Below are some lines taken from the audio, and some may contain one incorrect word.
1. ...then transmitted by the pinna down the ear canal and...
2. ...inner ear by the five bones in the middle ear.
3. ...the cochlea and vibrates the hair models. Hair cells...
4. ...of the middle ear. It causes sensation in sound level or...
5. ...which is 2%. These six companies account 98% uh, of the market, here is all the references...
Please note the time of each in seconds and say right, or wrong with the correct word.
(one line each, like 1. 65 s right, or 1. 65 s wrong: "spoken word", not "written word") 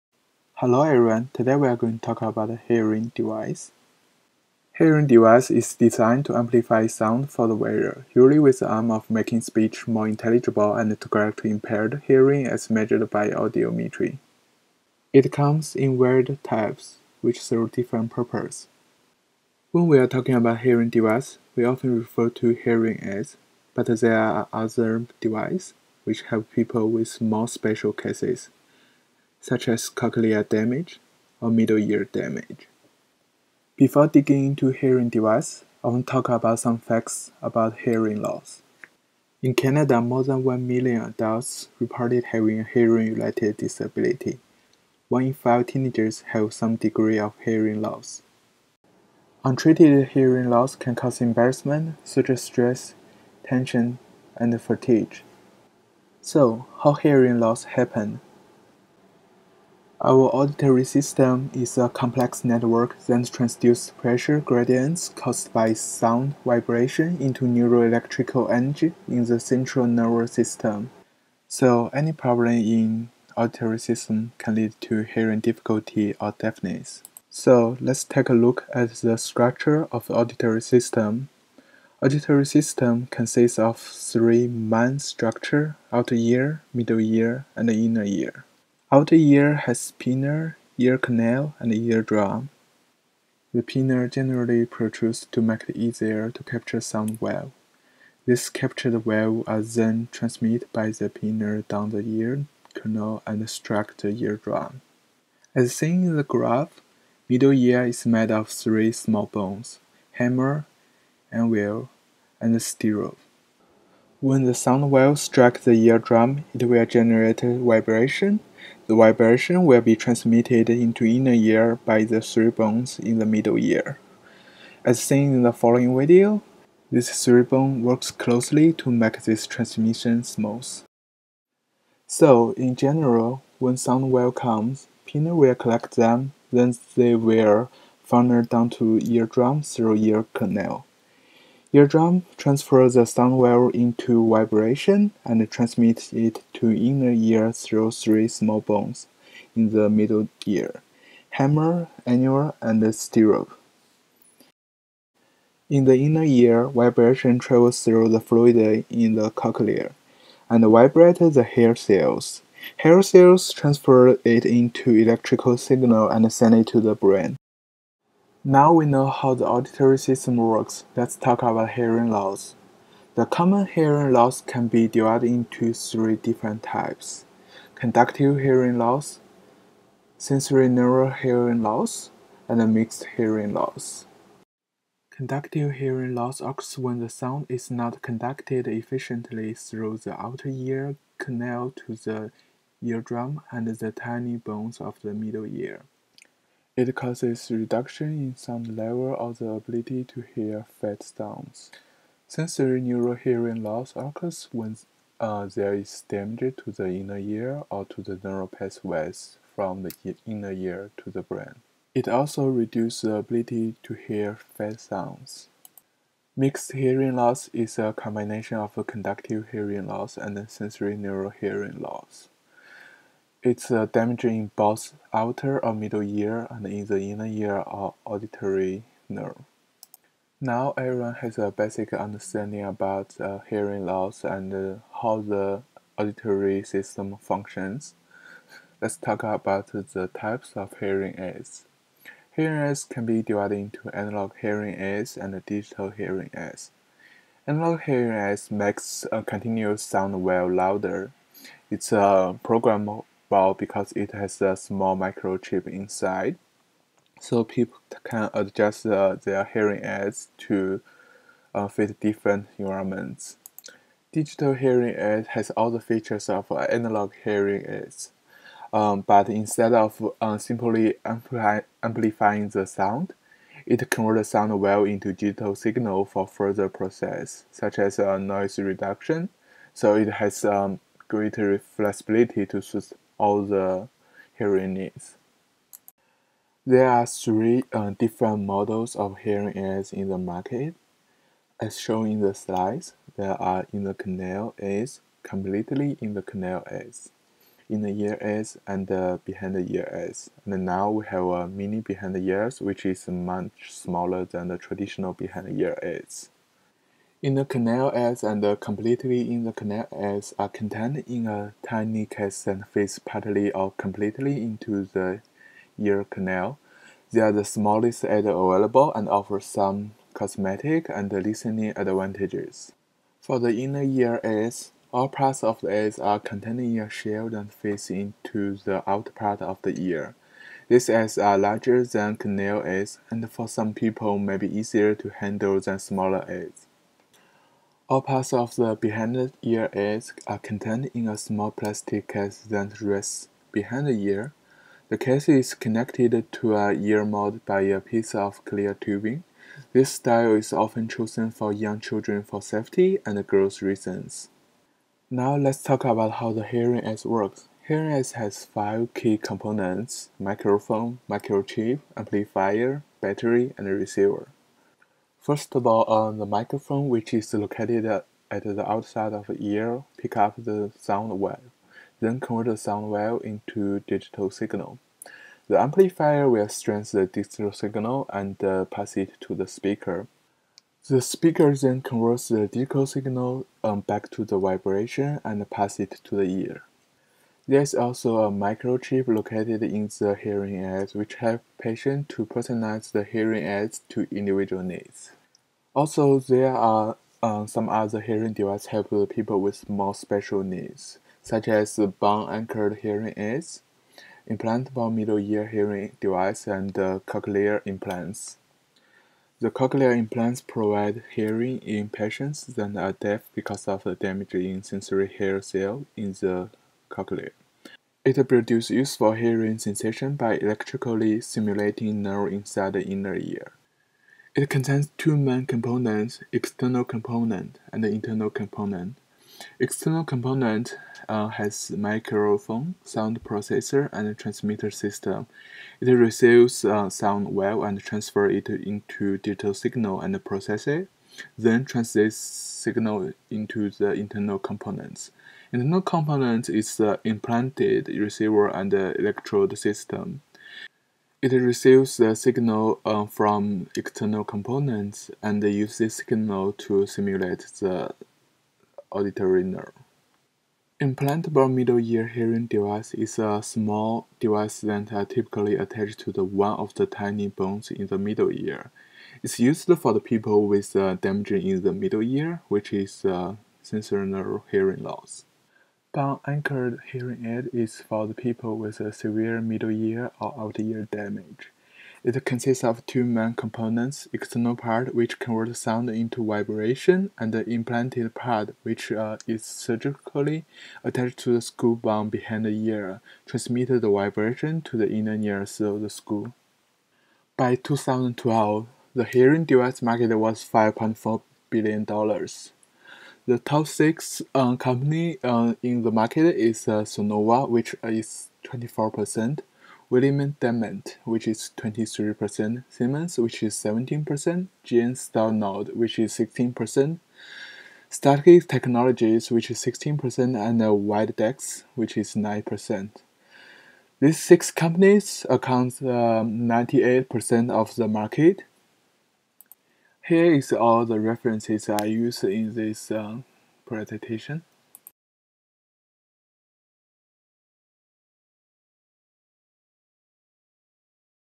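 1. 99 s right
2. 121 s wrong: "three", not "five"
3. 159 s wrong: "cells", not "models"
4. 194 s wrong: "reduction", not "sensation"
5. 521 s wrong: "9", not "2".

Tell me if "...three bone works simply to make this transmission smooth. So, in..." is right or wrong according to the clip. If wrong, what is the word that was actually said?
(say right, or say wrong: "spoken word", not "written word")
wrong: "closely", not "simply".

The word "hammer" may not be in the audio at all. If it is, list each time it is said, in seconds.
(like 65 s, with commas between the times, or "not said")
110 s, 151 s.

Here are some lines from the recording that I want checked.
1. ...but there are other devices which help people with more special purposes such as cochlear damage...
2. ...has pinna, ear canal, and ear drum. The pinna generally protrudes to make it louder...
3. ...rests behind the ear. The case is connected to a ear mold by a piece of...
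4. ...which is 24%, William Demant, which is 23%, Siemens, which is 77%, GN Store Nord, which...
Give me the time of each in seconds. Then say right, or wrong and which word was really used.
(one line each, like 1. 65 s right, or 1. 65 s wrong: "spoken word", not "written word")
1. 23 s wrong: "cases", not "purposes"
2. 89 s wrong: "easier", not "louder"
3. 342 s right
4. 507 s wrong: "17", not "77".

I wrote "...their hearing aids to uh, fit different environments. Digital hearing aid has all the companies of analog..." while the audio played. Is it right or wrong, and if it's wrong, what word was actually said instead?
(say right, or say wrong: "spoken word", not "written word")
wrong: "features", not "companies".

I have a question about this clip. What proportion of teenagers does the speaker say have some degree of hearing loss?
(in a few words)
One in five.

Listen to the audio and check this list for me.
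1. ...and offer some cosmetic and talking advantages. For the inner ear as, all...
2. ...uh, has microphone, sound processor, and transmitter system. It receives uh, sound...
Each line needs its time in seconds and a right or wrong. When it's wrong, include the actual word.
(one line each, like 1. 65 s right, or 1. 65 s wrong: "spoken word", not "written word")
1. 318 s wrong: "listening", not "talking"
2. 431 s right.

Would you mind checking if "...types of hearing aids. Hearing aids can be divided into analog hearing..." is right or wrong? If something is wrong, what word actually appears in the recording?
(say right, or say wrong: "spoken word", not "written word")
right.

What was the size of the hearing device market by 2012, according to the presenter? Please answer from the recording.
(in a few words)
$5.4 billion.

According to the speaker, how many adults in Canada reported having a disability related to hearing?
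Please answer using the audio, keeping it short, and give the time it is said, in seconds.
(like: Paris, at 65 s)
more than 1 million, at 39 s.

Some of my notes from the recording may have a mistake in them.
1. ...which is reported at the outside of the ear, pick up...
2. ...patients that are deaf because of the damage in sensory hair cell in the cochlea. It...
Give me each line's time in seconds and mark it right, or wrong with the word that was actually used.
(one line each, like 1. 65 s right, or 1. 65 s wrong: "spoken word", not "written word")
1. 366 s wrong: "located", not "reported"
2. 411 s right.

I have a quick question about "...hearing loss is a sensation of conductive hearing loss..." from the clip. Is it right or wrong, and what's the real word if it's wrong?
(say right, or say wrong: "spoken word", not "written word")
wrong: "combination", not "sensation".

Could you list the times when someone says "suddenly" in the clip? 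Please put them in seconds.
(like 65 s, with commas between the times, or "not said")
not said.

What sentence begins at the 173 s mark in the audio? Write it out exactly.
The common hearing loss can be divided into three different types.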